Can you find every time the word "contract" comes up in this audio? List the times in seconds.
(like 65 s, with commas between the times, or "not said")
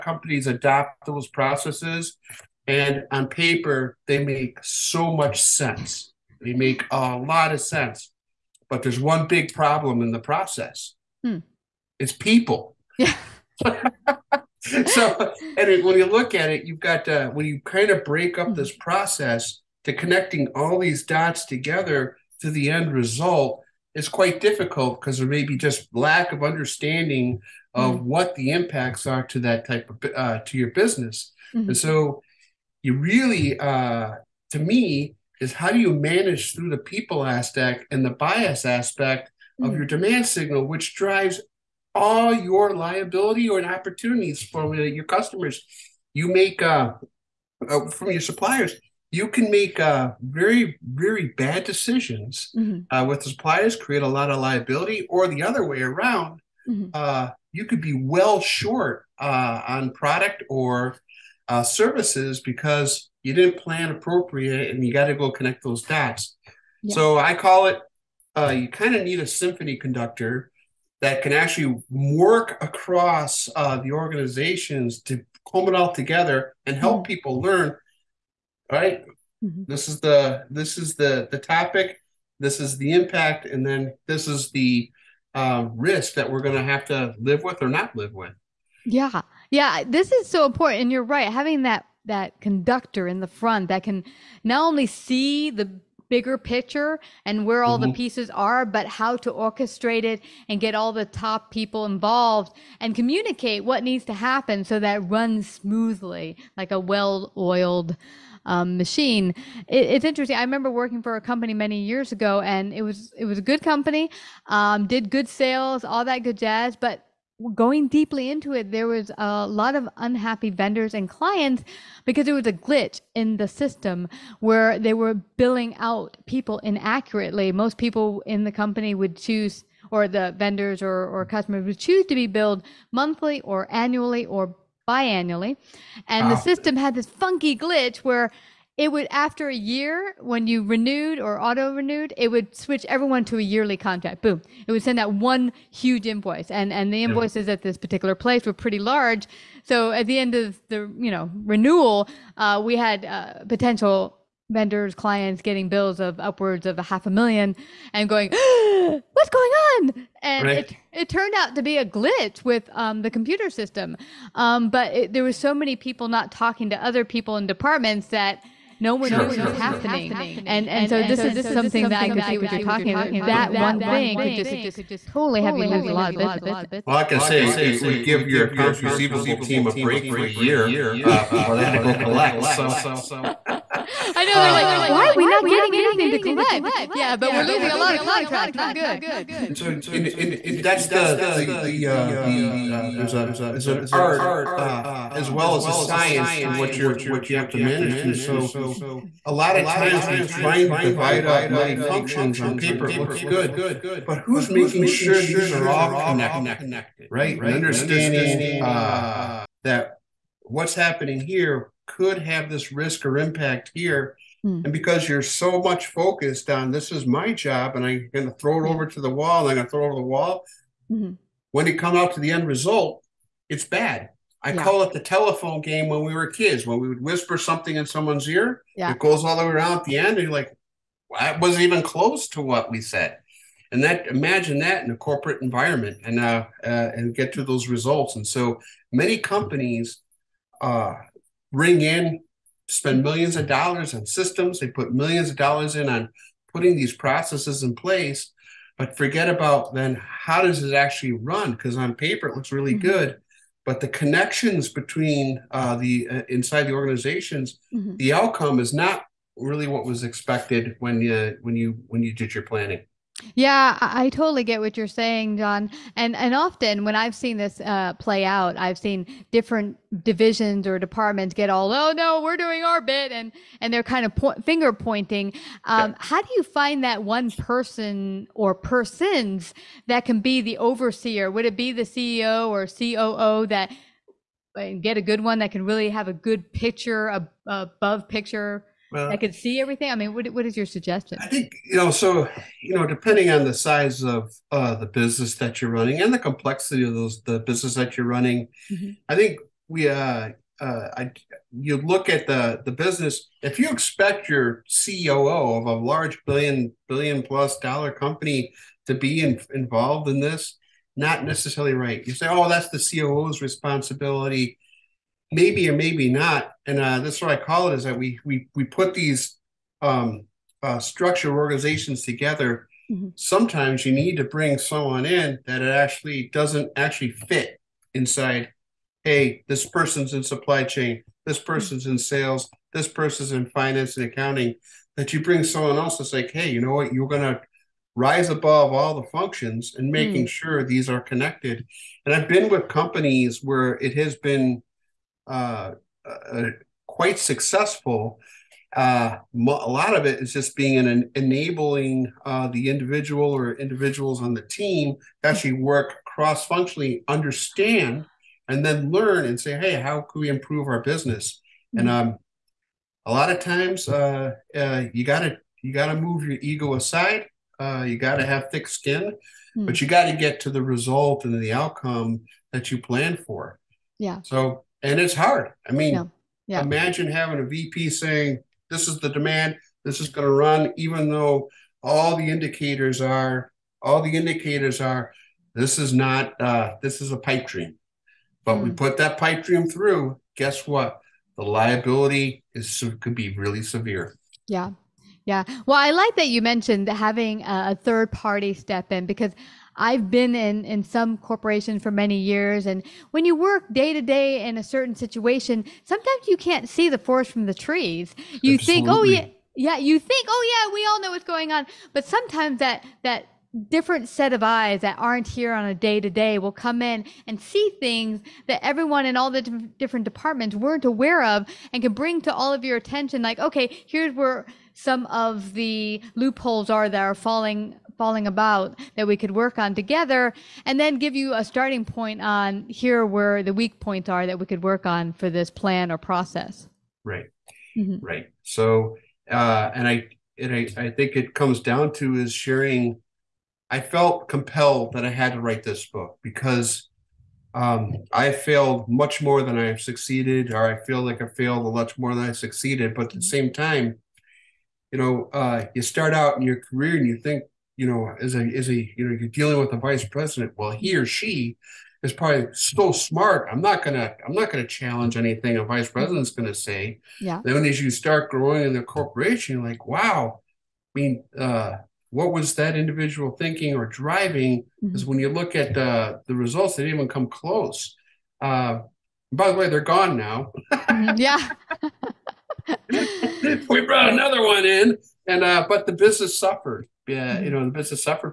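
143 s, 187 s.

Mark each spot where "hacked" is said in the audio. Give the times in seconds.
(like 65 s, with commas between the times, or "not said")
not said.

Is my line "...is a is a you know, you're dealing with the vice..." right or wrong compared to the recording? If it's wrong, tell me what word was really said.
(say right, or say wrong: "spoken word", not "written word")
right.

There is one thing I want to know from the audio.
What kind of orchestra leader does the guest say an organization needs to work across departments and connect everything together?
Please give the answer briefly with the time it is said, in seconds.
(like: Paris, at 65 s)
Symphony conductor, at 69 s.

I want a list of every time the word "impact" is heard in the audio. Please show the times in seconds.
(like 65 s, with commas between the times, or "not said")
28 s, 82 s, 213 s.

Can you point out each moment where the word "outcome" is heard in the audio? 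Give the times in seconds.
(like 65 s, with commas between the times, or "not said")
258 s, 371 s.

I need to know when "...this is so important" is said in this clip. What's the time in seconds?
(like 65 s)
89 s.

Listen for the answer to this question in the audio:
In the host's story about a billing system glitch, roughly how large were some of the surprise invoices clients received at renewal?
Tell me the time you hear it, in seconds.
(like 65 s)
156 s.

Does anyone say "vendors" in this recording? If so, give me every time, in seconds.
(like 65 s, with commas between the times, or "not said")
120 s, 130 s, 154 s.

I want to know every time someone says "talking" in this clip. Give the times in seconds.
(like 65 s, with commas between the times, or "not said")
166 s, 172 s.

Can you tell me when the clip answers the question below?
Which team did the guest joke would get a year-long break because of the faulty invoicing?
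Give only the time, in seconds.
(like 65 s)
178 s.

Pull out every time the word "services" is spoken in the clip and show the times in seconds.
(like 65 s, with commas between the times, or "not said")
61 s.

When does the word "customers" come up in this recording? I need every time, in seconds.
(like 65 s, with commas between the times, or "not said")
45 s, 131 s.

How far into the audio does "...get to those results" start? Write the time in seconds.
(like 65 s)
237 s.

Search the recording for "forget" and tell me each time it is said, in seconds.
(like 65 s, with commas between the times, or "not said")
248 s.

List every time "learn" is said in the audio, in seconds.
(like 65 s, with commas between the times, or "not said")
77 s, 358 s.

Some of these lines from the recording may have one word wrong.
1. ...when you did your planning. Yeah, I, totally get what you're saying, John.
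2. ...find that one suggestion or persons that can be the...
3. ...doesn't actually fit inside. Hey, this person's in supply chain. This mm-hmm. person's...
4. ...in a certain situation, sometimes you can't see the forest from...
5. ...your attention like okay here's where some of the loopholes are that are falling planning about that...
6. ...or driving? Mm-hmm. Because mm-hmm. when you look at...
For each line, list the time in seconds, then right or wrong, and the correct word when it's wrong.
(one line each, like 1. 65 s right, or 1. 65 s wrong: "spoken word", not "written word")
1. 261 s right
2. 276 s wrong: "person", not "suggestion"
3. 326 s right
4. 404 s right
5. 422 s wrong: "falling", not "planning"
6. 473 s right.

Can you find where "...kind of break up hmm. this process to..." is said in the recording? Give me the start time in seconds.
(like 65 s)
17 s.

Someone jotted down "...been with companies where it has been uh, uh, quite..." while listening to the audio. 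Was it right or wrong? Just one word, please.
right.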